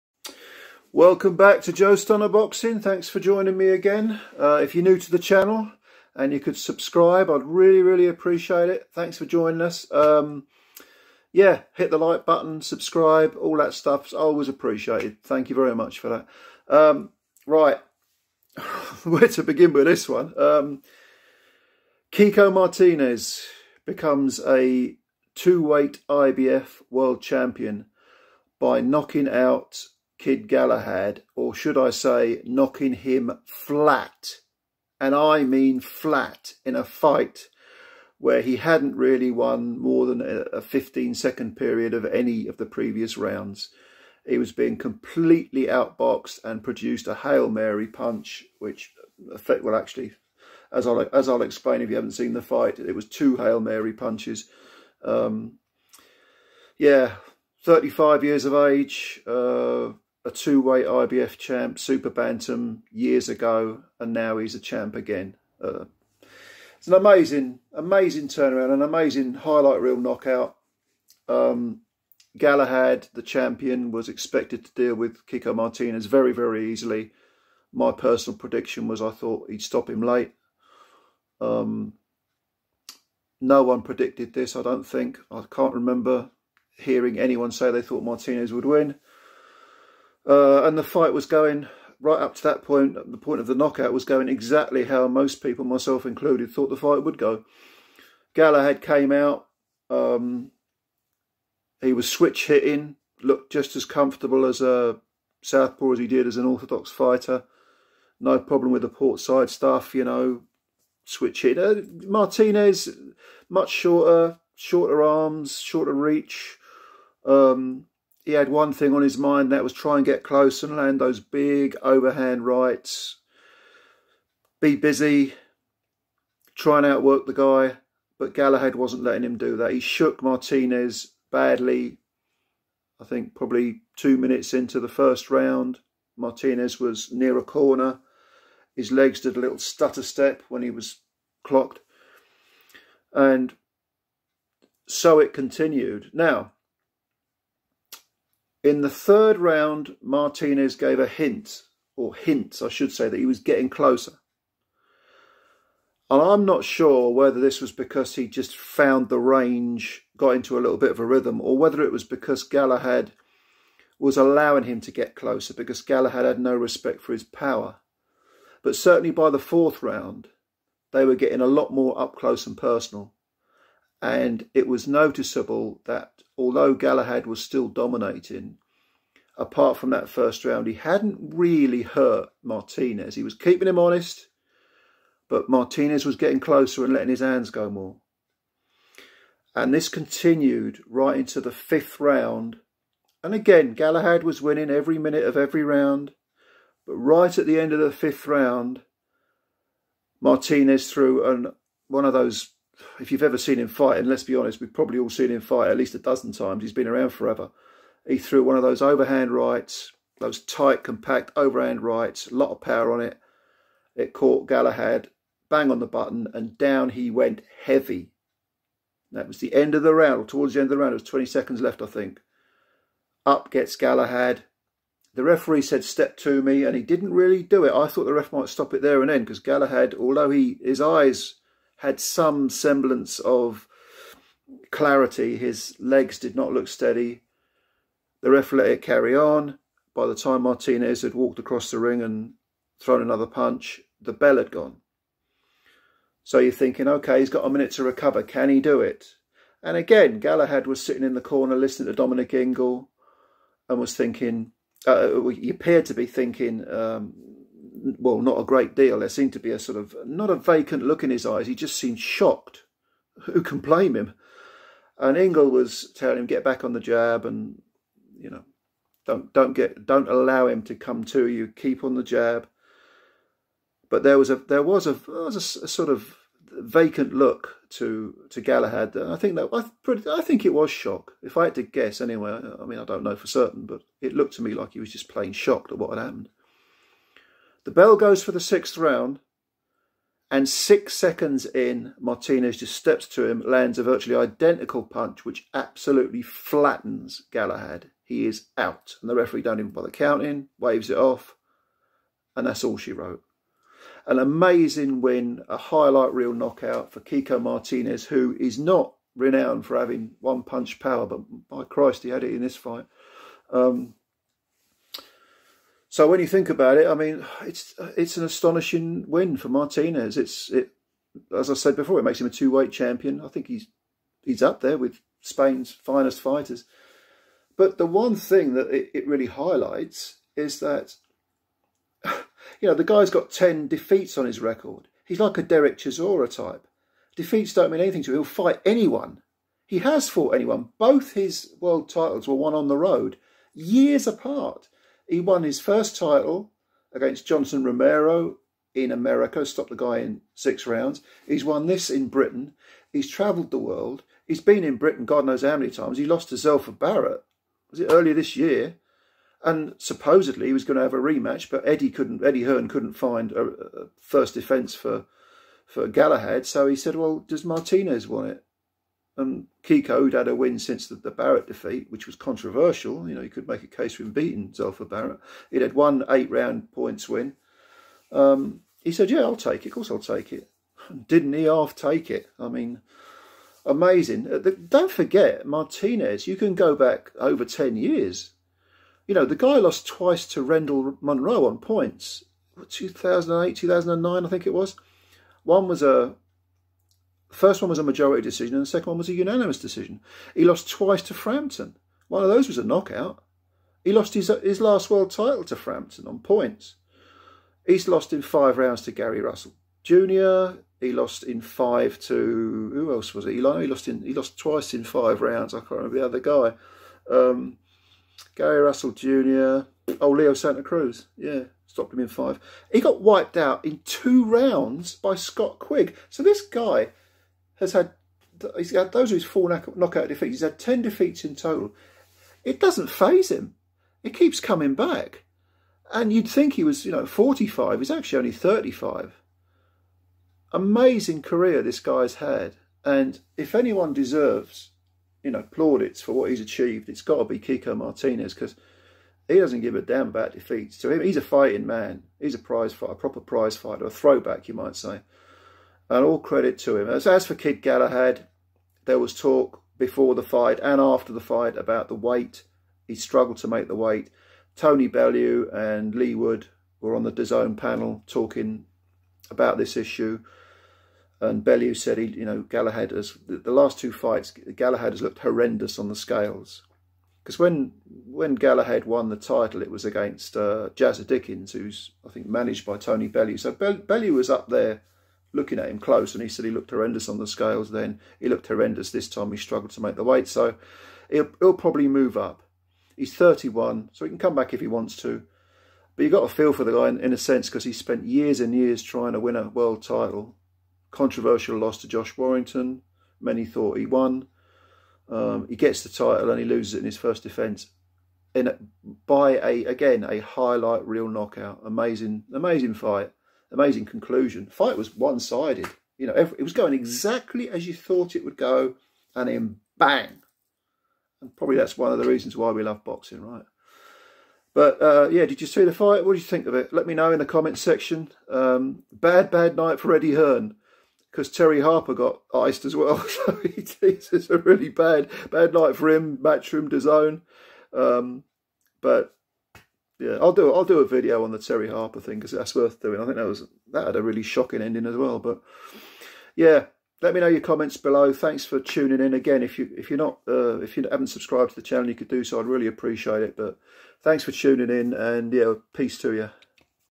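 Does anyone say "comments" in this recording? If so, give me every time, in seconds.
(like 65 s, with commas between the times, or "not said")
527 s, 547 s.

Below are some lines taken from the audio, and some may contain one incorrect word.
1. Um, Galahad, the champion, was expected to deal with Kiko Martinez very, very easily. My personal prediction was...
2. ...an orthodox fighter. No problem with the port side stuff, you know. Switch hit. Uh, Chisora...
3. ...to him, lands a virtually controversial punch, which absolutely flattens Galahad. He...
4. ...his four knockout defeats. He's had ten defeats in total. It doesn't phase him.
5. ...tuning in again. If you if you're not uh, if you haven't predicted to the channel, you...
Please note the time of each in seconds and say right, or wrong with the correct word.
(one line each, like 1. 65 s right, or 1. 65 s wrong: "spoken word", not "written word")
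1. 71 s right
2. 106 s wrong: "Martinez", not "Chisora"
3. 293 s wrong: "identical", not "controversial"
4. 429 s right
5. 548 s wrong: "subscribed", not "predicted".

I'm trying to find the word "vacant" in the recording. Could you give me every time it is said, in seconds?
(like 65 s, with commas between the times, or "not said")
260 s, 276 s.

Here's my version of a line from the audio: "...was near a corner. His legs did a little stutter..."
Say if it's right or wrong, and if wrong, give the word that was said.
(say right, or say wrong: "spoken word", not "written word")
right.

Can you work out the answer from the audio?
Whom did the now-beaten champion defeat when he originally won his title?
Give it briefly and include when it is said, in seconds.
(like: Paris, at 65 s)
Jazza Dickens, at 480 s.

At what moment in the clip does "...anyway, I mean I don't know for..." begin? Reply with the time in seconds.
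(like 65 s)
281 s.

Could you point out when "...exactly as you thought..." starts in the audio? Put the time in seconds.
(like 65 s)
516 s.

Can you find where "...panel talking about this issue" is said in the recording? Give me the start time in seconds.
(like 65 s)
467 s.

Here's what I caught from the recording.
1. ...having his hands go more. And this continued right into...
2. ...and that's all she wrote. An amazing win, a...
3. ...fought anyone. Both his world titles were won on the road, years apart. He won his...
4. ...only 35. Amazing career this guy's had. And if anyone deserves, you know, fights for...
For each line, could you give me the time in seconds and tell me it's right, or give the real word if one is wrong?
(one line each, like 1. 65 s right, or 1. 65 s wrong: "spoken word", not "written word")
1. 186 s wrong: "letting", not "having"
2. 302 s right
3. 340 s right
4. 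438 s wrong: "plaudits", not "fights".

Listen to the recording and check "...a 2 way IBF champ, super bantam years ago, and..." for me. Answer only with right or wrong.
right.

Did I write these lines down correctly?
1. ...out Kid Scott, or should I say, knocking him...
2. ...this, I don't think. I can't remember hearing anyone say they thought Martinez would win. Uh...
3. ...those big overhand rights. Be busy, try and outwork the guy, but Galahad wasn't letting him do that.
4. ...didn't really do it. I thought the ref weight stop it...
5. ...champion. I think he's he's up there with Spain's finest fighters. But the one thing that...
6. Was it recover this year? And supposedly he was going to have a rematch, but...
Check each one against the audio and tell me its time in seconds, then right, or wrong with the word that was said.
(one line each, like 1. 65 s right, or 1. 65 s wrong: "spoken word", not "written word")
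1. 29 s wrong: "Galahad", not "Scott"
2. 84 s right
3. 121 s right
4. 226 s wrong: "might", not "weight"
5. 322 s right
6. 357 s wrong: "earlier", not "recover".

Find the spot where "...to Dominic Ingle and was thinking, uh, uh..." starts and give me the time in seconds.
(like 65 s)
251 s.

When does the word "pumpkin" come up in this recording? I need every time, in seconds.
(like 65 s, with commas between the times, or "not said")
not said.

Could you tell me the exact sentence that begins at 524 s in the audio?
But uh, yeah, did you see the fight?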